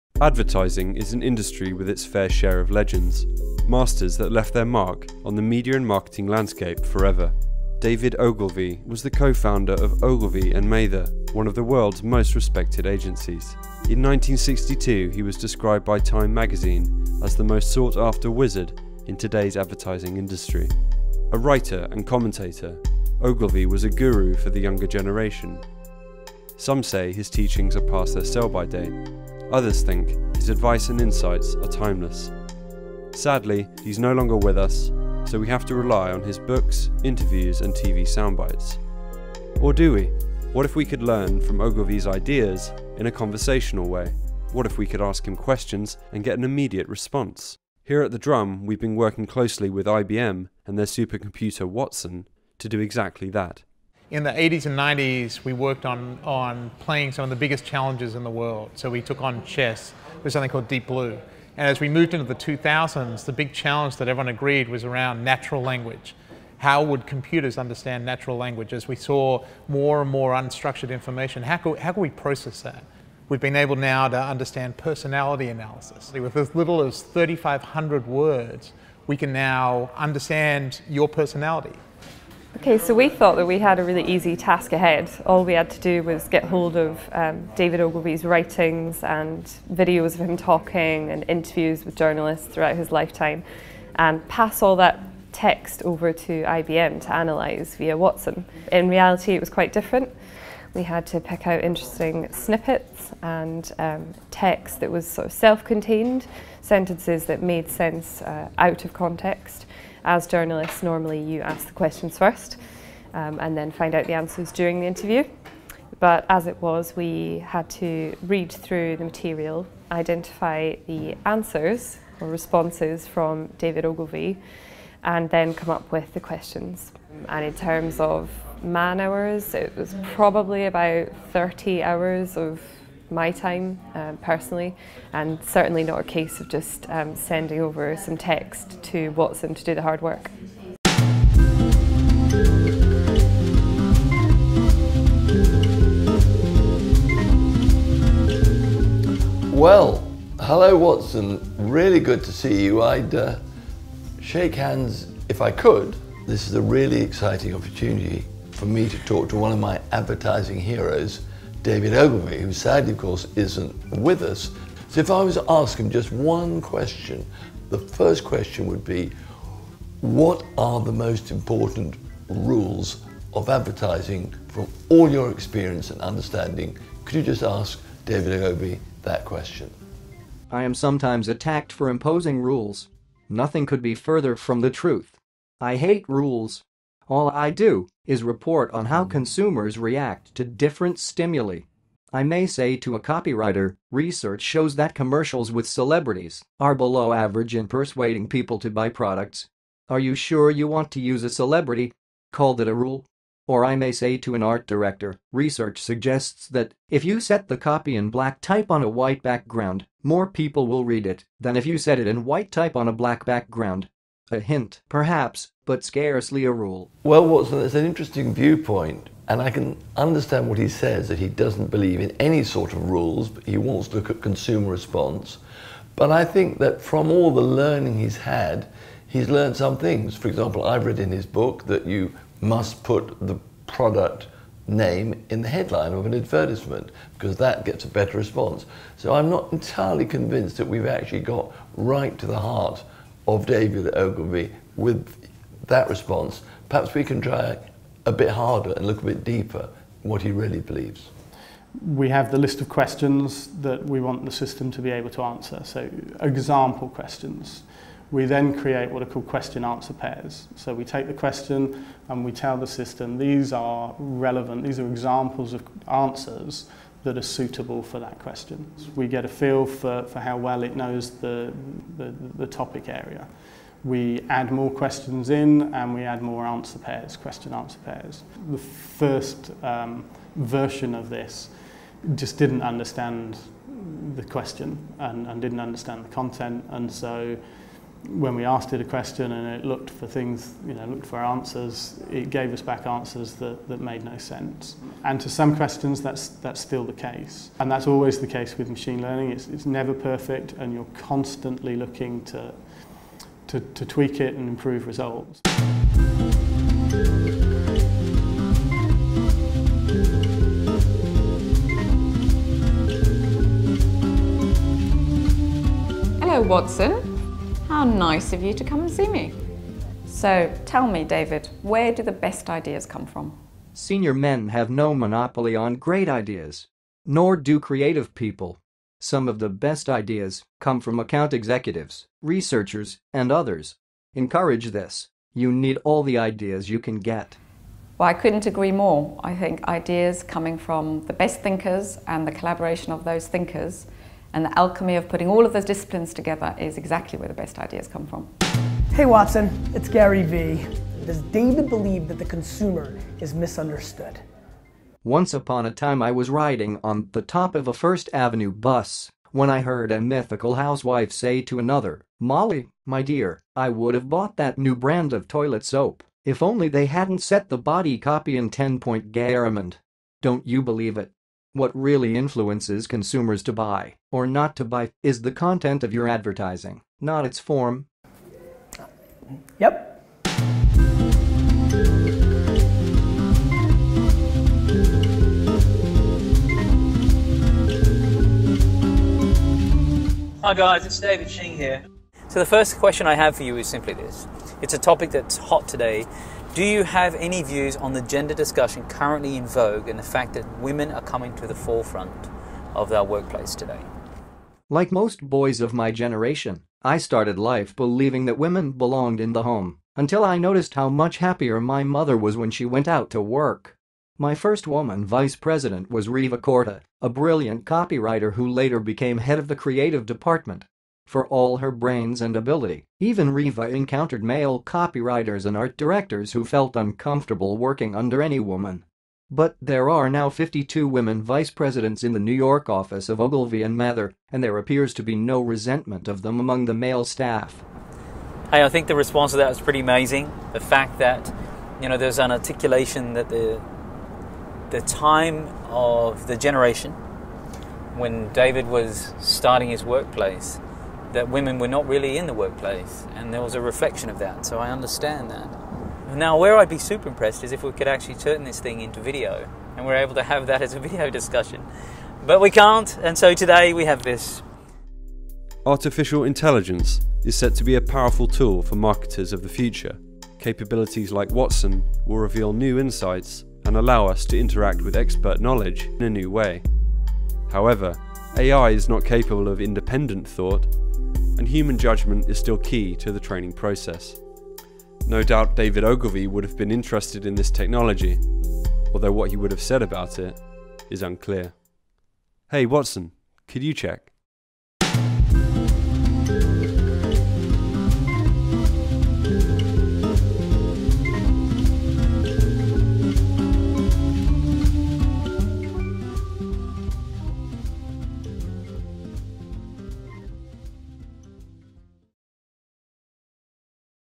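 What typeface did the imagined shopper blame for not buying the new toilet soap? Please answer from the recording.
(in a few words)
Garamond.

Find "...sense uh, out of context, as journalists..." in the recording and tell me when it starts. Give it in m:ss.
1:47.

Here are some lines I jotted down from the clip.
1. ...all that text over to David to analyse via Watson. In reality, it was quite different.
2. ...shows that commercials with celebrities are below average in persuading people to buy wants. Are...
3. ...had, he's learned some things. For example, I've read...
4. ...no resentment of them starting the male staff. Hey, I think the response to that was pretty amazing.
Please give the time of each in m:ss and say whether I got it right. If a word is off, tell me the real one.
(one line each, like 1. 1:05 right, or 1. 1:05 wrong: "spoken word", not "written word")
1. 1:34 wrong: "IBM", not "David"
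2. 3:14 wrong: "products", not "wants"
3. 3:48 right
4. 7:15 wrong: "among", not "starting".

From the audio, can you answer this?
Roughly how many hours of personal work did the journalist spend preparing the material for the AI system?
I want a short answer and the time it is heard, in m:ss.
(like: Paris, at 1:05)
30 hours, at 2:11.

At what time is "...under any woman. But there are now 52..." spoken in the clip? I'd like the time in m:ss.
7:07.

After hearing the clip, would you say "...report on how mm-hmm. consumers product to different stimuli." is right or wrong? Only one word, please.
wrong.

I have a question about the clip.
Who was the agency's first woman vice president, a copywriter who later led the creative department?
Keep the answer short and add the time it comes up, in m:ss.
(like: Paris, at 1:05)
Reva Korda, at 6:56.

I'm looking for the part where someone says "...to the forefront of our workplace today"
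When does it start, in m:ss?
6:41.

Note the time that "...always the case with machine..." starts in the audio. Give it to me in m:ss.
4:57.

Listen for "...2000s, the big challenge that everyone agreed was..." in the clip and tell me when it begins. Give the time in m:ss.
1:02.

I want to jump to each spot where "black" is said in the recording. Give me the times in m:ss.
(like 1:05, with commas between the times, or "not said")
3:28, 3:32.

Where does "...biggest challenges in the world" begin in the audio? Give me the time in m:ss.
0:57.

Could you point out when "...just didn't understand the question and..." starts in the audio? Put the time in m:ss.
4:42.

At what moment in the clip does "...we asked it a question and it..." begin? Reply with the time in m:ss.
4:48.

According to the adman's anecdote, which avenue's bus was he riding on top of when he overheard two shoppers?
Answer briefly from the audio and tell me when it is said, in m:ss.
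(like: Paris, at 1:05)
First Avenue, at 5:57.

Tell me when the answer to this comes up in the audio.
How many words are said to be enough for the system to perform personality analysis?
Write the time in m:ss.
1:17.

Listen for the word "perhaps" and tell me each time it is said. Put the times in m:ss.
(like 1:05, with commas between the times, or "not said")
3:34, 4:06.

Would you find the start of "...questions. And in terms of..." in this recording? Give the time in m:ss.
2:06.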